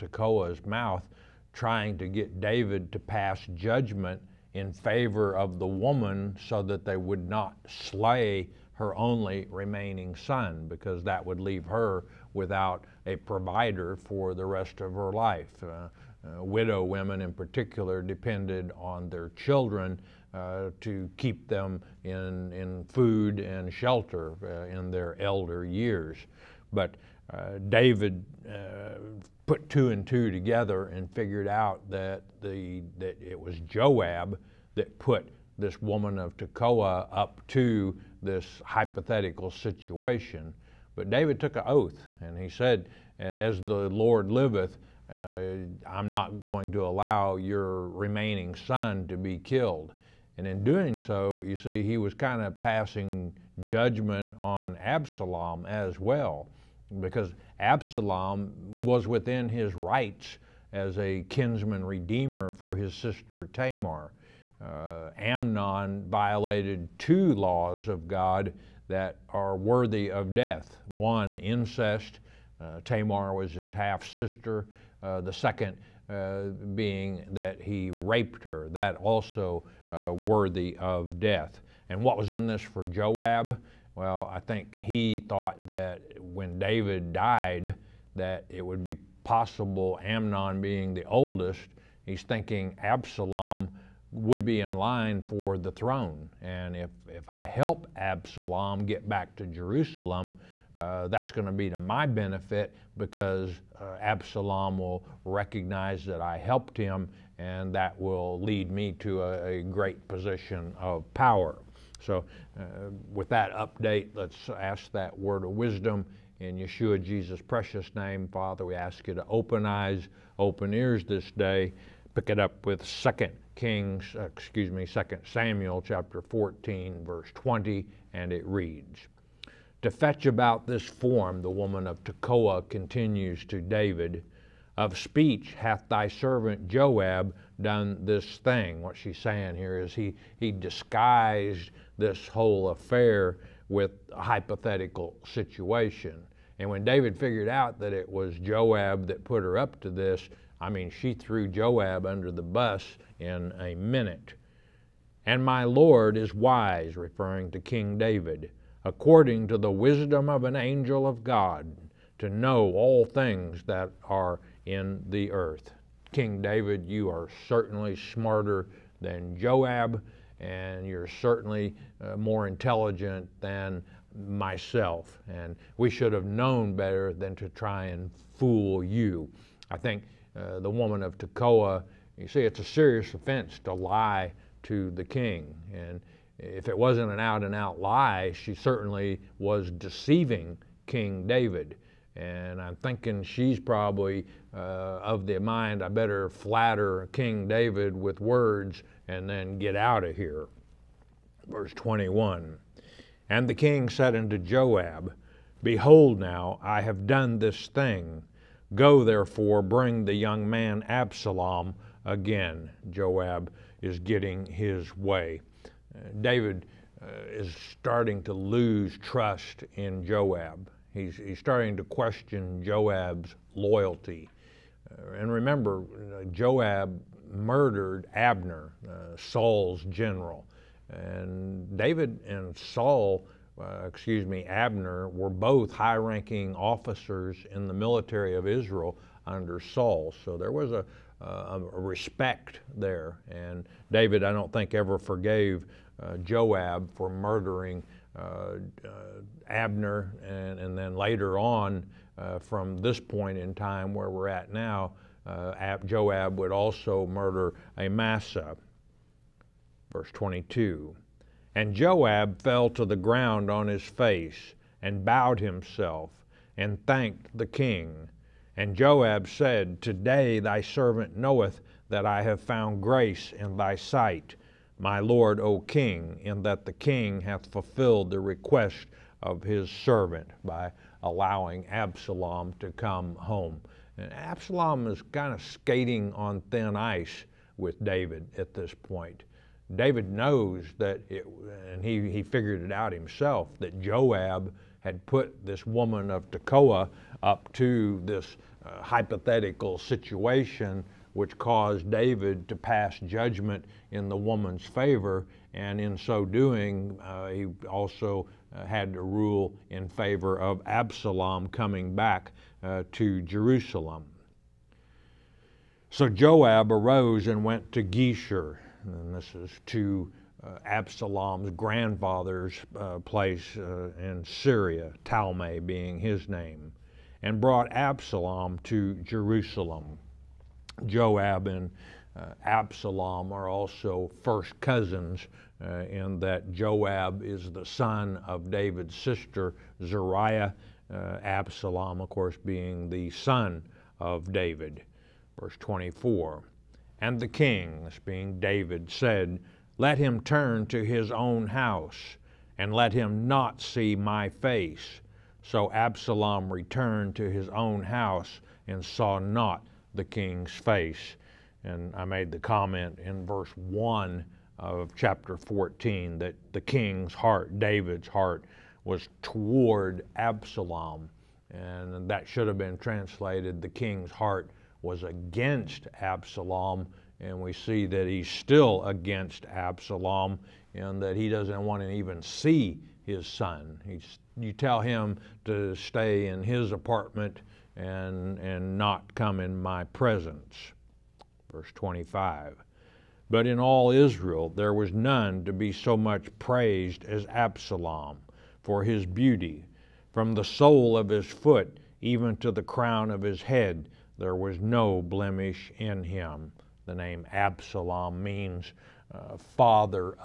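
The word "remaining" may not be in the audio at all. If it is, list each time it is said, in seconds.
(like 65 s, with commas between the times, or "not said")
9 s, 47 s.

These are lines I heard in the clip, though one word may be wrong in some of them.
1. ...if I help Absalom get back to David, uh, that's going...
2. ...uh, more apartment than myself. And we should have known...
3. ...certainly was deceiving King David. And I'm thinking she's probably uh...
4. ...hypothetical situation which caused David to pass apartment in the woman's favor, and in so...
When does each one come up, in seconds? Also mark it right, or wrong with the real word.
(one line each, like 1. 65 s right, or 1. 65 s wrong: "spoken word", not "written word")
1. 97 s wrong: "Jerusalem", not "David"
2. 172 s wrong: "intelligent", not "apartment"
3. 188 s right
4. 298 s wrong: "judgment", not "apartment".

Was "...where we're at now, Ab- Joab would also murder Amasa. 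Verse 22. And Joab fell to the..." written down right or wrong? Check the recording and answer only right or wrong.
right.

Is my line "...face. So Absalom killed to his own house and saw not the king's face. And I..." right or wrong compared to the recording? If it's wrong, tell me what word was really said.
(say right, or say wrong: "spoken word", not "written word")
wrong: "returned", not "killed".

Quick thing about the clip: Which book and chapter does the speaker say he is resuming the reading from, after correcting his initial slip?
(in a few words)
2 Samuel chapter 14.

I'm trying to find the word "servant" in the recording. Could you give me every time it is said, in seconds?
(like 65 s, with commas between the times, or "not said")
136 s, 270 s, 279 s.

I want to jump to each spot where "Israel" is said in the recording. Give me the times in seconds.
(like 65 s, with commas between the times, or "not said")
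238 s, 393 s.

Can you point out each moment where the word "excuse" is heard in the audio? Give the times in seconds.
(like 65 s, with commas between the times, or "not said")
124 s, 233 s.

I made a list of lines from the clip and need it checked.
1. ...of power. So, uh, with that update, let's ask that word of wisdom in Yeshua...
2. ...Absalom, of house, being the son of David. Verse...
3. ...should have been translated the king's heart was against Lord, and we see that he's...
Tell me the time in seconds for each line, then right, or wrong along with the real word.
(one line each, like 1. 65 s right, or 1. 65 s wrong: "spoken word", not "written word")
1. 110 s right
2. 341 s wrong: "course", not "house"
3. 372 s wrong: "Absalom", not "Lord".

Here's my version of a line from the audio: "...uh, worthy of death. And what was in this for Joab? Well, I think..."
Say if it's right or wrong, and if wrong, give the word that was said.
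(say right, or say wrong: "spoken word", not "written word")
right.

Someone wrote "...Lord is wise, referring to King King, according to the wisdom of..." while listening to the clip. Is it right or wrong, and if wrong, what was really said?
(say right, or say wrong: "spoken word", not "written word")
wrong: "David", not "King".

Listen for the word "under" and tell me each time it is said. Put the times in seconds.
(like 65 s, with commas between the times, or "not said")
152 s, 239 s.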